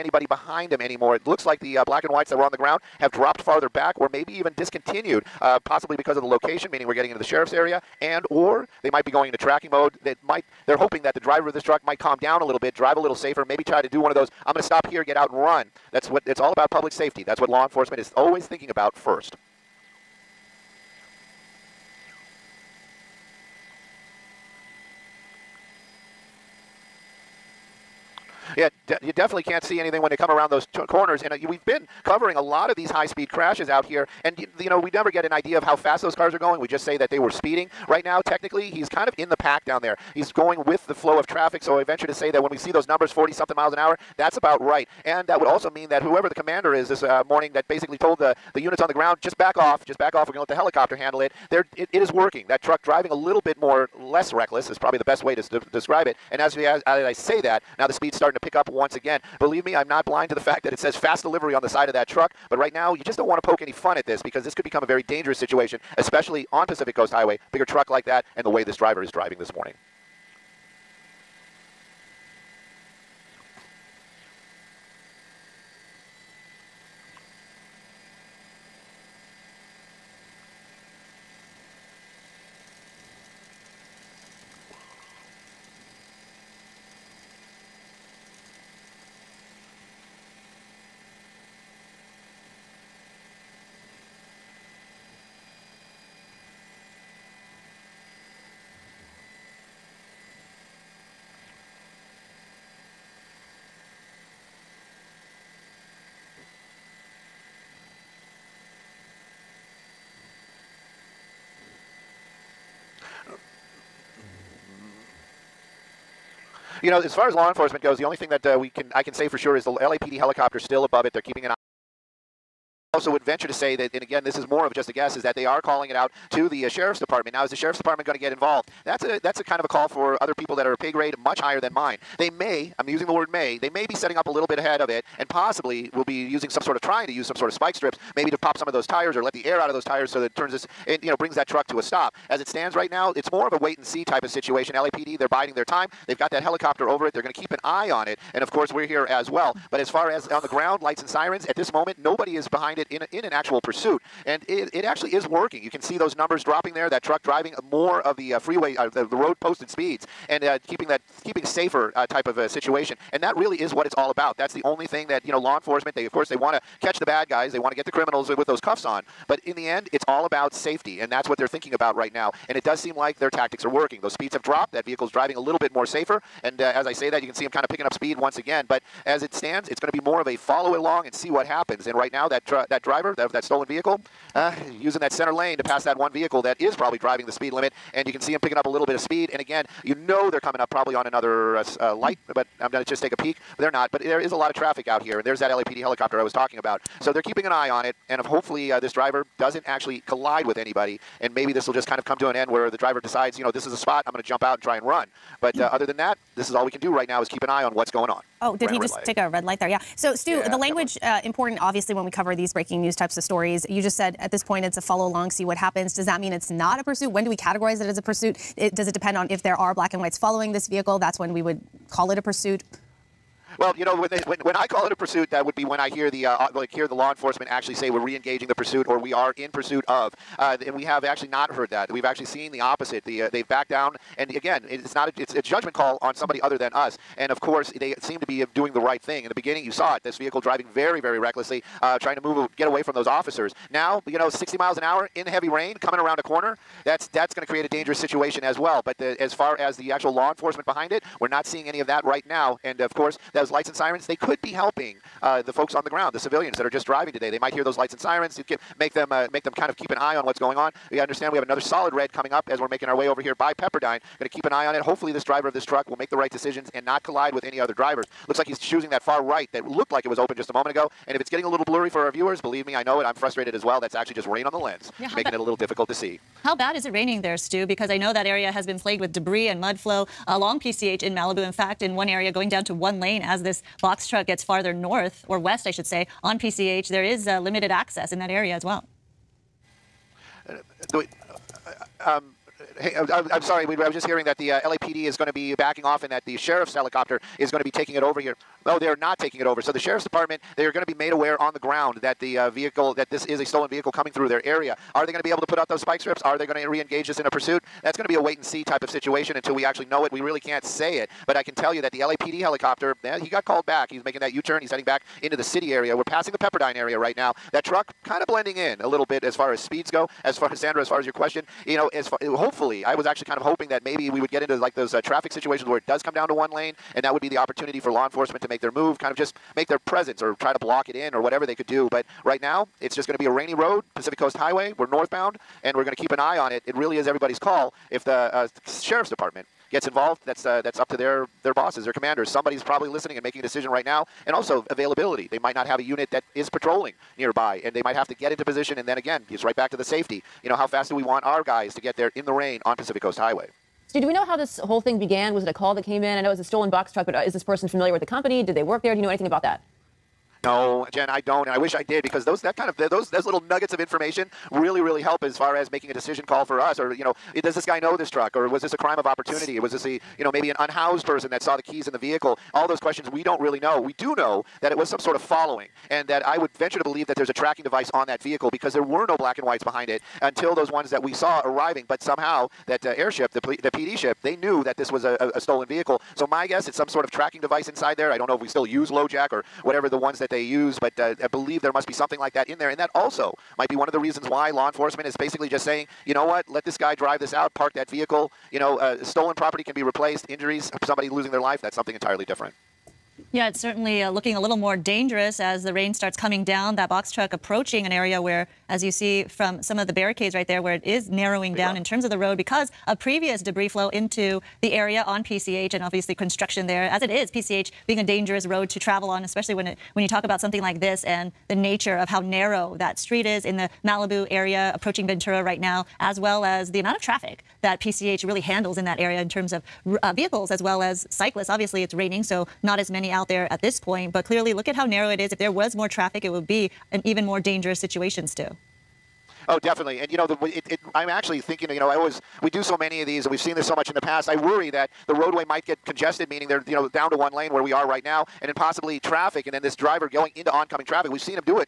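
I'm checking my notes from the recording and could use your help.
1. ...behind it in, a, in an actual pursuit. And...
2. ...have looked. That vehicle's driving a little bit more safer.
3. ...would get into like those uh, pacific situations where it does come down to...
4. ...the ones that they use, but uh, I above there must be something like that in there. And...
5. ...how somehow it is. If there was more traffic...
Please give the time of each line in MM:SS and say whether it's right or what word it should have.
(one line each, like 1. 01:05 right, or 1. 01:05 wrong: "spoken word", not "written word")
1. 02:32 right
2. 02:54 wrong: "dropped", not "looked"
3. 05:24 wrong: "traffic", not "pacific"
4. 06:29 wrong: "believe", not "above"
5. 07:14 wrong: "narrow", not "somehow".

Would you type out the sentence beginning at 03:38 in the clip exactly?
It, does it depend on if there are black and whites following this vehicle?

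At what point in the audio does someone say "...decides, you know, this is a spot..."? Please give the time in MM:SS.
03:23.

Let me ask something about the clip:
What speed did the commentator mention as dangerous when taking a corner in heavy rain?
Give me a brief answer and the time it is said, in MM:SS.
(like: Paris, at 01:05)
60 miles an hour, at 04:04.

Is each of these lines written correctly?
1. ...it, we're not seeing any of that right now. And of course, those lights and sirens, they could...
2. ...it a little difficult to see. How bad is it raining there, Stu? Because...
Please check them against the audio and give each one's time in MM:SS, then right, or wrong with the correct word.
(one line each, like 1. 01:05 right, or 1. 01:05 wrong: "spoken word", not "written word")
1. 04:10 right
2. 04:35 right.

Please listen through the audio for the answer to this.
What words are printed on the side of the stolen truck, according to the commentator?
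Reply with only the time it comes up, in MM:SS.
01:00.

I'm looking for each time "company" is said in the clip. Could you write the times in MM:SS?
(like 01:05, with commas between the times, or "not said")
05:58.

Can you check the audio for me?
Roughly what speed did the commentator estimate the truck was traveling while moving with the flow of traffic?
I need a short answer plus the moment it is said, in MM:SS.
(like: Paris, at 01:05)
40-something miles an hour, at 00:43.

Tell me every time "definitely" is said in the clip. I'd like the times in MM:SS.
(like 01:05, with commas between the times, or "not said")
00:29, 07:19.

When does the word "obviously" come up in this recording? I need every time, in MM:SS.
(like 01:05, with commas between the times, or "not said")
03:31, 06:55, 07:11.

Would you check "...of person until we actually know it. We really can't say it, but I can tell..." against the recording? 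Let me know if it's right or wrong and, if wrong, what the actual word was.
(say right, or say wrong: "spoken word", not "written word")
wrong: "situation", not "person".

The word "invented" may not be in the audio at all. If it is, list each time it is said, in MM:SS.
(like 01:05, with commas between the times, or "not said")
not said.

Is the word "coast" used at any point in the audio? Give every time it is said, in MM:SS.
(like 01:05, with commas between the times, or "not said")
01:06, 05:34, 05:53.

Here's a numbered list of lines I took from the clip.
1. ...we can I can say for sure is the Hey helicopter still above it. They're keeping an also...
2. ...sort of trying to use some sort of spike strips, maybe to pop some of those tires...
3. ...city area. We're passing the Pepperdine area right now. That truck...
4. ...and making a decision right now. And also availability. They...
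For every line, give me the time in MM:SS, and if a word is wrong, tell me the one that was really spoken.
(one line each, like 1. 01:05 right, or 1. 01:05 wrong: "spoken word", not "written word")
1. 01:58 wrong: "LAPD", not "Hey"
2. 02:16 right
3. 05:15 right
4. 05:43 right.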